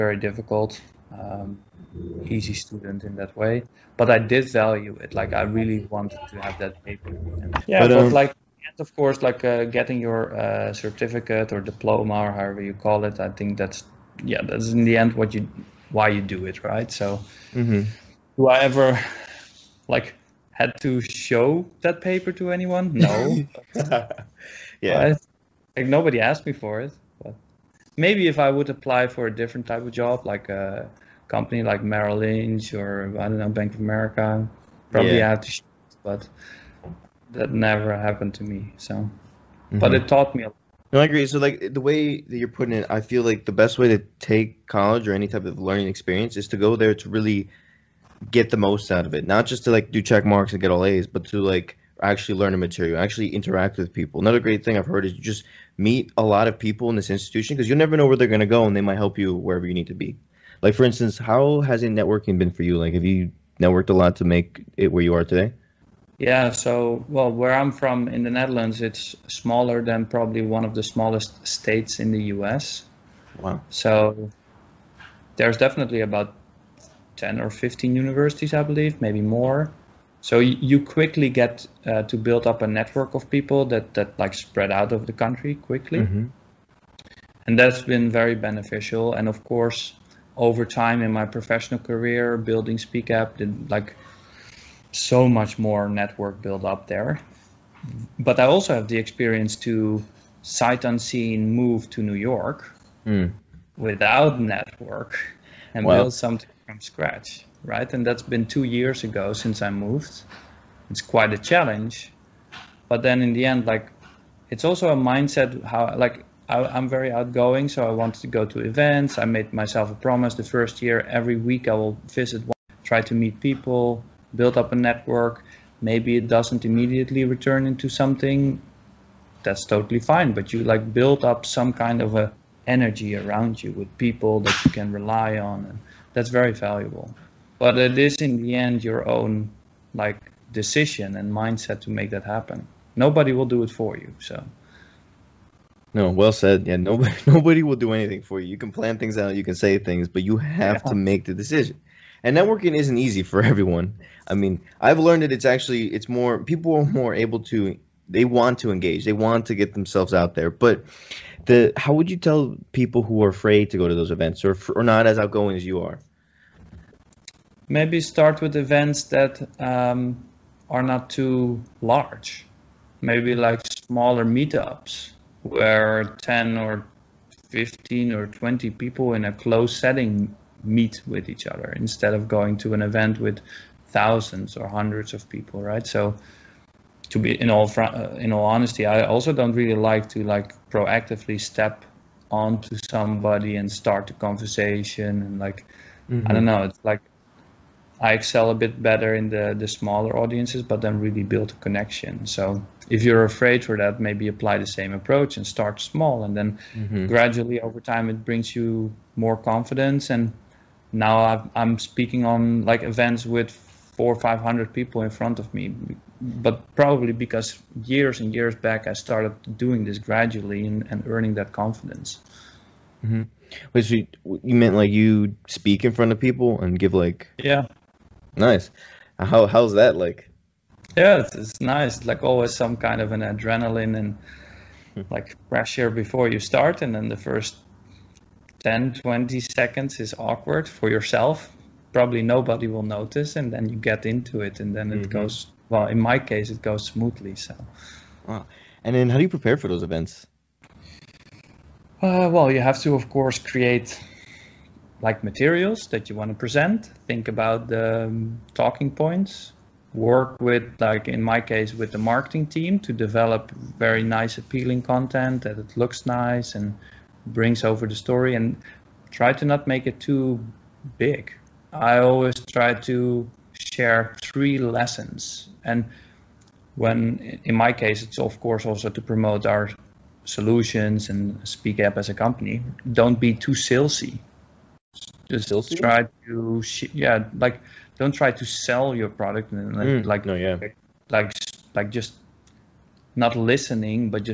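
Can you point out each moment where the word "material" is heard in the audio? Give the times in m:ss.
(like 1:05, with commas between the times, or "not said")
0:52, 4:15.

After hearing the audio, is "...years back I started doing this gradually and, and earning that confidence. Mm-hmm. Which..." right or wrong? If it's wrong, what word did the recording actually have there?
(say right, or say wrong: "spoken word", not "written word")
right.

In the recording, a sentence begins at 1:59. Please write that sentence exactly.
I made myself a promise the first year every week I will visit, one, try to meet people, build up a network.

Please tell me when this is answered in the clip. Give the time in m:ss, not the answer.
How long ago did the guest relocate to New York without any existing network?
1:48.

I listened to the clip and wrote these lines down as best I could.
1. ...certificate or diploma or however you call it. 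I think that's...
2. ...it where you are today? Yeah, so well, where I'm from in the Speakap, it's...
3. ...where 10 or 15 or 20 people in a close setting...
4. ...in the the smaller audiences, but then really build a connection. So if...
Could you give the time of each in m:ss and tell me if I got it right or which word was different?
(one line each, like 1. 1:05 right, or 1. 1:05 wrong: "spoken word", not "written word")
1. 0:10 right
2. 1:04 wrong: "Netherlands", not "Speakap"
3. 2:55 right
4. 3:19 right.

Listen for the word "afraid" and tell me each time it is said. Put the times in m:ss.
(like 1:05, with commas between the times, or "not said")
2:43, 3:23.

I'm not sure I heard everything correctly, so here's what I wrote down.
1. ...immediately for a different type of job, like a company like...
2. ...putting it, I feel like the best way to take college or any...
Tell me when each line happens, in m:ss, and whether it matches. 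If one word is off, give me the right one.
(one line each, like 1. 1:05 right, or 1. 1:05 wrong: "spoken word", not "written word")
1. 0:28 wrong: "apply", not "immediately"
2. 0:42 right.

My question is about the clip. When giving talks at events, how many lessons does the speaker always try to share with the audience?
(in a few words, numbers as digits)
3.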